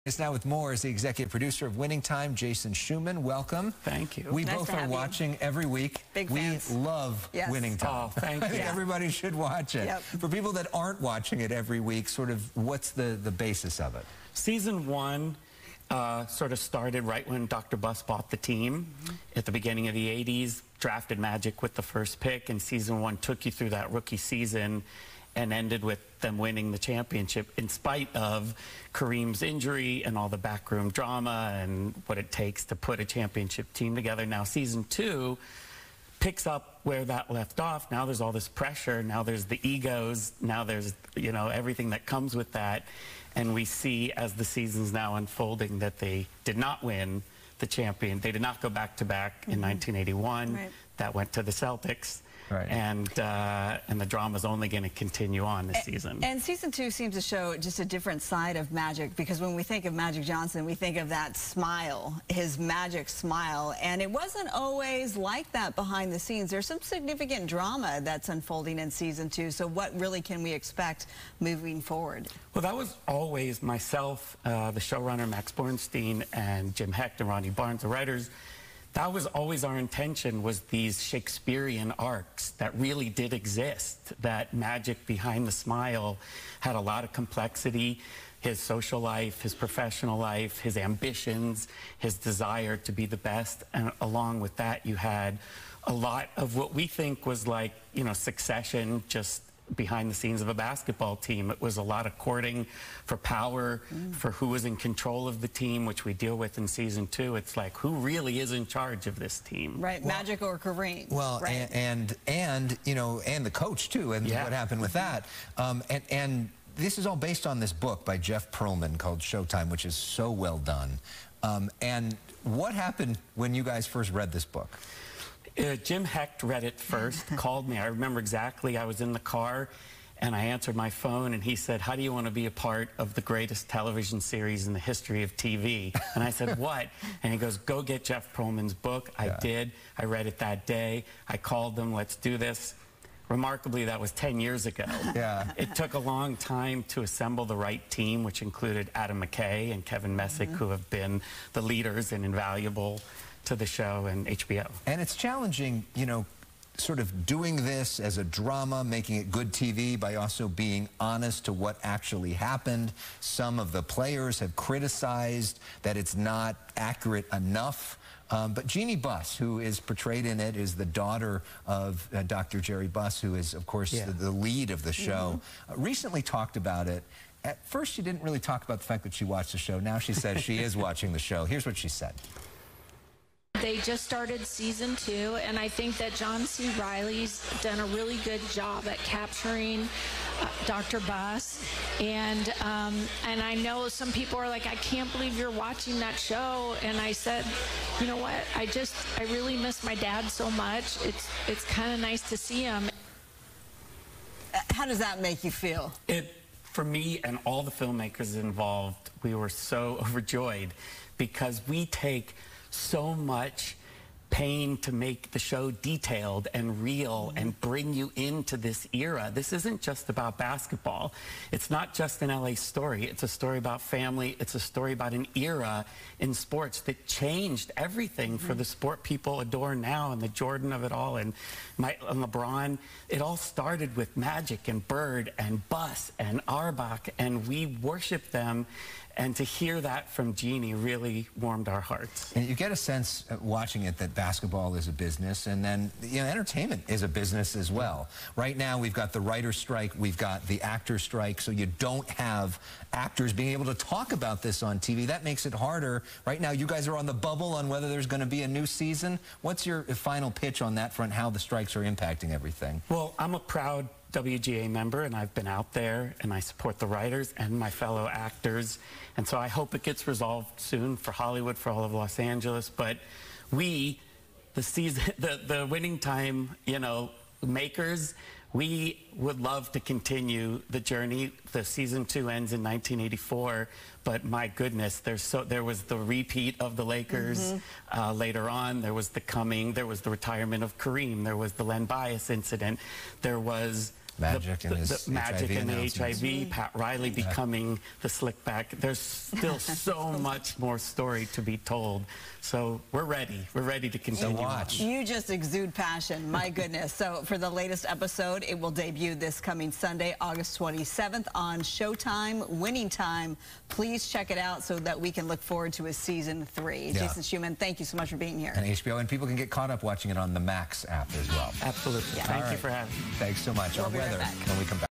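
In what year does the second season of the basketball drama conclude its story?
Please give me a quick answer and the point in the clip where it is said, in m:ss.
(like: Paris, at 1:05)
1984, at 4:42.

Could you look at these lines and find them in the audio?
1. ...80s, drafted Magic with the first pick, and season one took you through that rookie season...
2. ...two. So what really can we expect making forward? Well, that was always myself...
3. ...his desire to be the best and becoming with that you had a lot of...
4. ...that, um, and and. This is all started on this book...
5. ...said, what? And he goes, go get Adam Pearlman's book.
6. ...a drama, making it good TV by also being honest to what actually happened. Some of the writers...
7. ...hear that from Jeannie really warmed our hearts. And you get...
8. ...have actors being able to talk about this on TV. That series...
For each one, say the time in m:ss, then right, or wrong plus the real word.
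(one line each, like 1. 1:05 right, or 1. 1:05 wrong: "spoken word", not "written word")
1. 0:20 right
2. 1:09 wrong: "moving", not "making"
3. 1:31 wrong: "along", not "becoming"
4. 1:54 wrong: "based", not "started"
5. 2:16 wrong: "Jeff", not "Adam"
6. 2:38 wrong: "players", not "writers"
7. 3:59 right
8. 4:12 wrong: "makes", not "series".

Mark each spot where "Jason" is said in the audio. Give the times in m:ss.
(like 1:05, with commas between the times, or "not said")
0:02, 5:17.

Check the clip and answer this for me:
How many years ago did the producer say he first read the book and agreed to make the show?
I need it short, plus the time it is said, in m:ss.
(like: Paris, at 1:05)
10, at 2:24.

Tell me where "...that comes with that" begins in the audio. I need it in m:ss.
0:41.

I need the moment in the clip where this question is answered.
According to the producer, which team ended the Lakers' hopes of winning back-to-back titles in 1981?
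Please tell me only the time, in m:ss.
0:50.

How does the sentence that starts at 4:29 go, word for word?
And so I hope it gets resolved soon for Hollywood, for all of Los Angeles.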